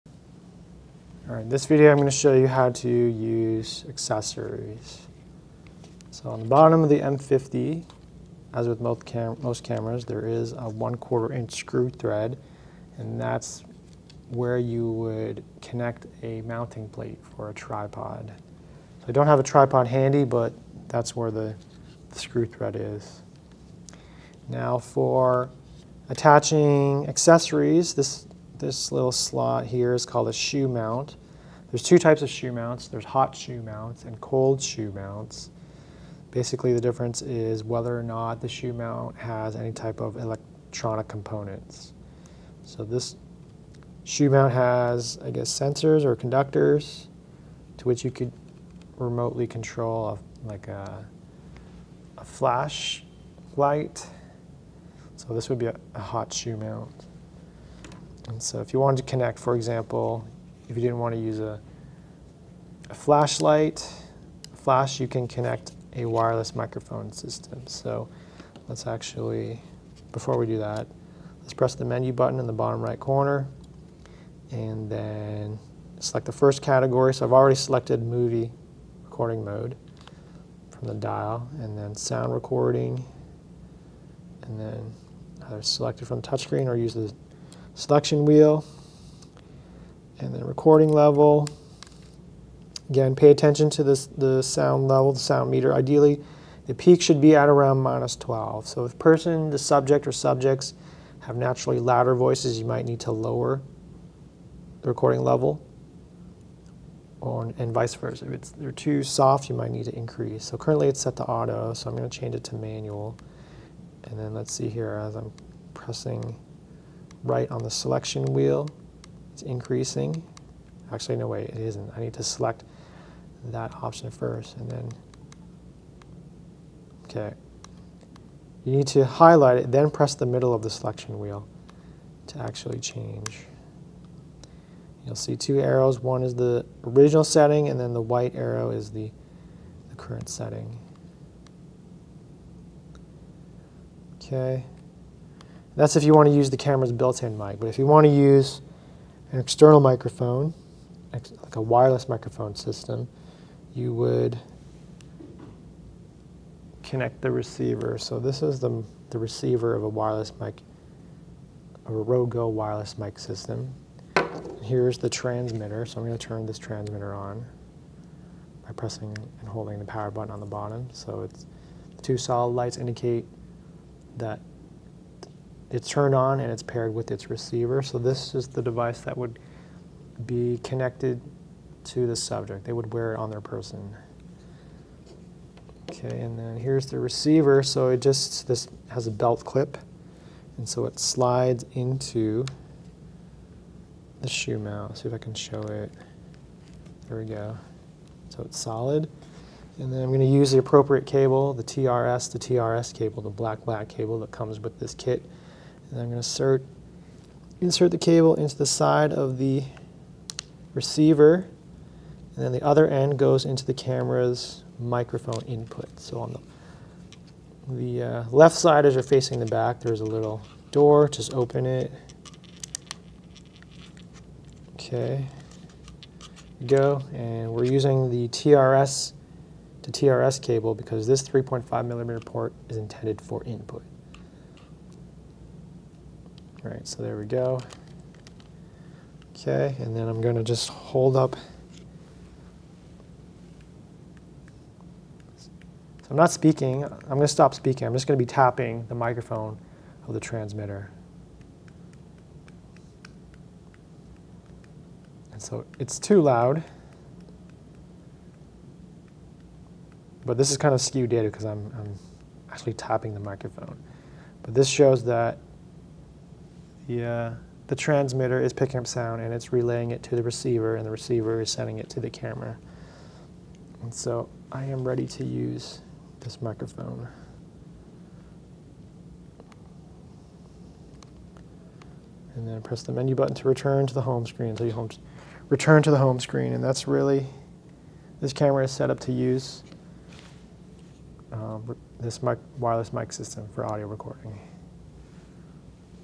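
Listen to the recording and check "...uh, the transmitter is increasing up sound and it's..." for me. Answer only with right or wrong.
wrong.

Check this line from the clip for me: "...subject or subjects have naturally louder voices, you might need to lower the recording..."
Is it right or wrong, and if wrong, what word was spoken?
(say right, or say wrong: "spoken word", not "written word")
right.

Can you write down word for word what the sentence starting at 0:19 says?
So I don't have a tripod handy, but that's where the, the screw thread is.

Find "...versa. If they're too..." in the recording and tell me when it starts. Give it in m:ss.
1:47.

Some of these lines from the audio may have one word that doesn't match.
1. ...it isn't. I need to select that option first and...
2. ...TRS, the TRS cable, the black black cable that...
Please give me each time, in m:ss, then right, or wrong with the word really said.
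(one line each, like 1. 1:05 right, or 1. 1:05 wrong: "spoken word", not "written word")
1. 2:01 right
2. 3:21 right.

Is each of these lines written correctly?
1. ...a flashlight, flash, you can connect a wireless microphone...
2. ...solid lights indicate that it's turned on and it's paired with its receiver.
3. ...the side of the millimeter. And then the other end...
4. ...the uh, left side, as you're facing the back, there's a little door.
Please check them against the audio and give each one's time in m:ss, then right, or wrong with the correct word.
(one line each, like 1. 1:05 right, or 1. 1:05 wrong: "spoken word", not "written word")
1. 1:02 right
2. 2:52 right
3. 3:28 wrong: "receiver", not "millimeter"
4. 3:37 right.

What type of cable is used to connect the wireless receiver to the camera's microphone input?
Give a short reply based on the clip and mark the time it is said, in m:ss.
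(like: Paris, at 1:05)
TRS to TRS, at 3:48.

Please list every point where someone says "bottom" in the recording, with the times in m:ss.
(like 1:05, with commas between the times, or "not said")
0:06, 1:12, 2:50.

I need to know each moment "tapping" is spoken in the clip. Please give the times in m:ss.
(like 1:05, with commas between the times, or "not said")
4:08, 4:22.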